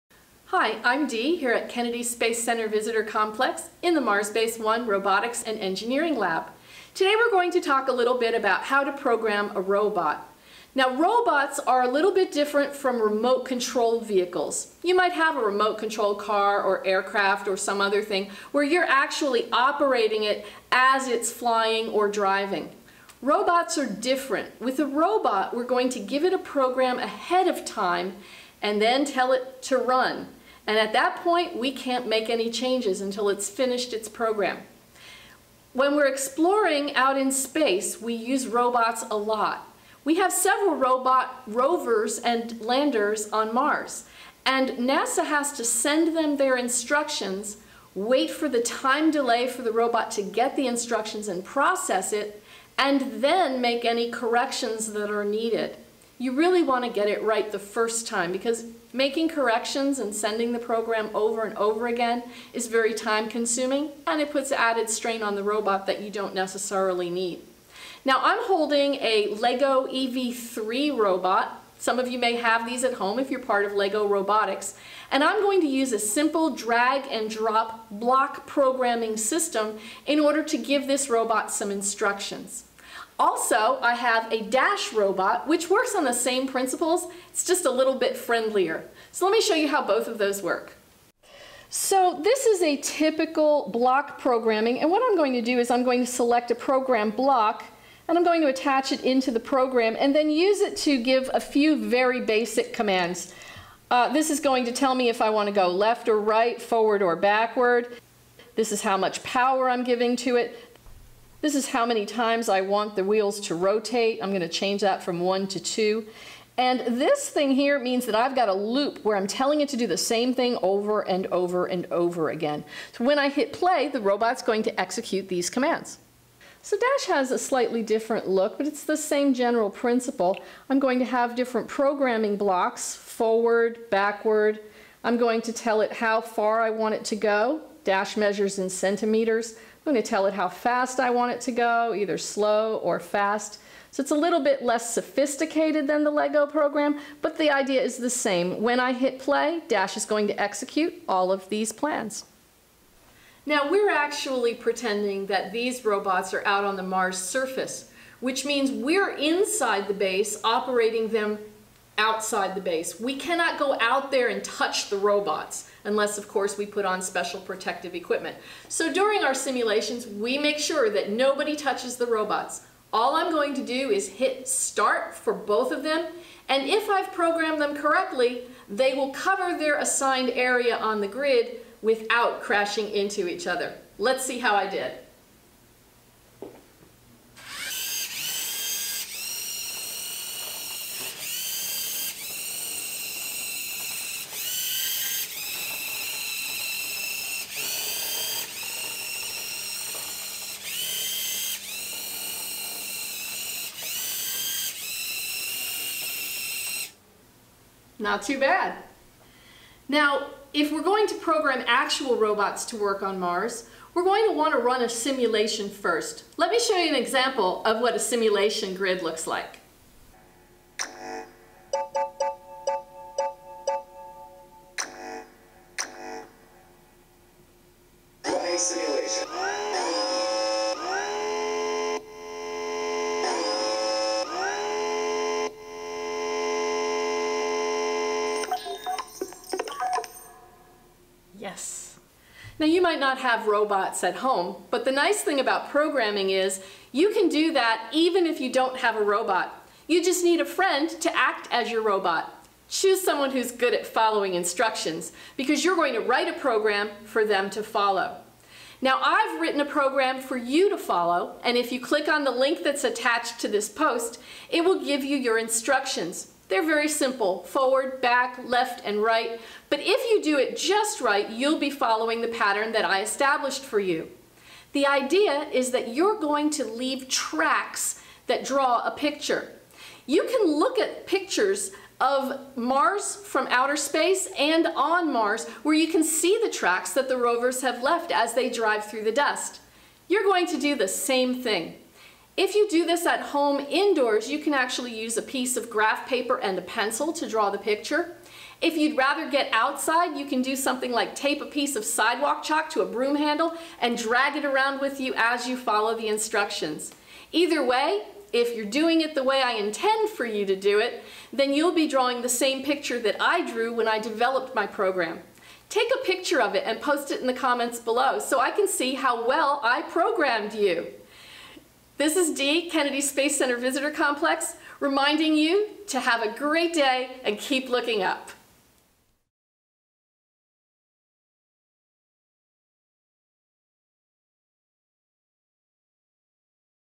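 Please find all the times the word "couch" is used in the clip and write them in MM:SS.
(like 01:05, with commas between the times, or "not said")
not said.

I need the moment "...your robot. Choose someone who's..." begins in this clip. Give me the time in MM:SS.
04:11.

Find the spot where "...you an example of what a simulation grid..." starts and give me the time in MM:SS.
03:36.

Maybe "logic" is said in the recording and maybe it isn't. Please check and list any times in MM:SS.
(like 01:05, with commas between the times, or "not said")
not said.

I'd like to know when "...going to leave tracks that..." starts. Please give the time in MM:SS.
04:36.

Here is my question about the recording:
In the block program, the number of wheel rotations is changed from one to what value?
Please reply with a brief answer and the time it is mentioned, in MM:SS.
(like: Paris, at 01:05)
2, at 01:55.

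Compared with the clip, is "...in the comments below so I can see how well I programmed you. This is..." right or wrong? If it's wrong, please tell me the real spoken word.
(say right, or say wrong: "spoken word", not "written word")
right.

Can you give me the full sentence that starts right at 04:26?
They're very simple, forward, back, left, and right.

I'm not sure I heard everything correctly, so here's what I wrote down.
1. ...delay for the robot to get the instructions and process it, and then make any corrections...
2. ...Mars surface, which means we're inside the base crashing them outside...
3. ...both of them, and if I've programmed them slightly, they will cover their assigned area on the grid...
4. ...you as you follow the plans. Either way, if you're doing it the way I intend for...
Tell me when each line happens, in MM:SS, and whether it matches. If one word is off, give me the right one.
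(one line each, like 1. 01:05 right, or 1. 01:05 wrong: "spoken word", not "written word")
1. 00:49 right
2. 02:36 wrong: "operating", not "crashing"
3. 02:55 wrong: "correctly", not "slightly"
4. 05:04 wrong: "instructions", not "plans".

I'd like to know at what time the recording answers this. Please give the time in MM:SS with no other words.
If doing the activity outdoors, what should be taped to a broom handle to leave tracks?
05:01.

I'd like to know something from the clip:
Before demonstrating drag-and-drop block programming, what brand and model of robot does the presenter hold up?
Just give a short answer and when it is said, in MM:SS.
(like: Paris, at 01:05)
LEGO EV3, at 01:09.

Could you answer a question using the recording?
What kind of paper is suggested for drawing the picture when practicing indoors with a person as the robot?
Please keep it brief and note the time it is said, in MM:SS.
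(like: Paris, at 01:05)
graph paper, at 04:55.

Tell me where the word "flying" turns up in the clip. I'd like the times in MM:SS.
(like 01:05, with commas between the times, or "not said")
00:21.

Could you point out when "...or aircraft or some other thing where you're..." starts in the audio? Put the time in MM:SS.
00:16.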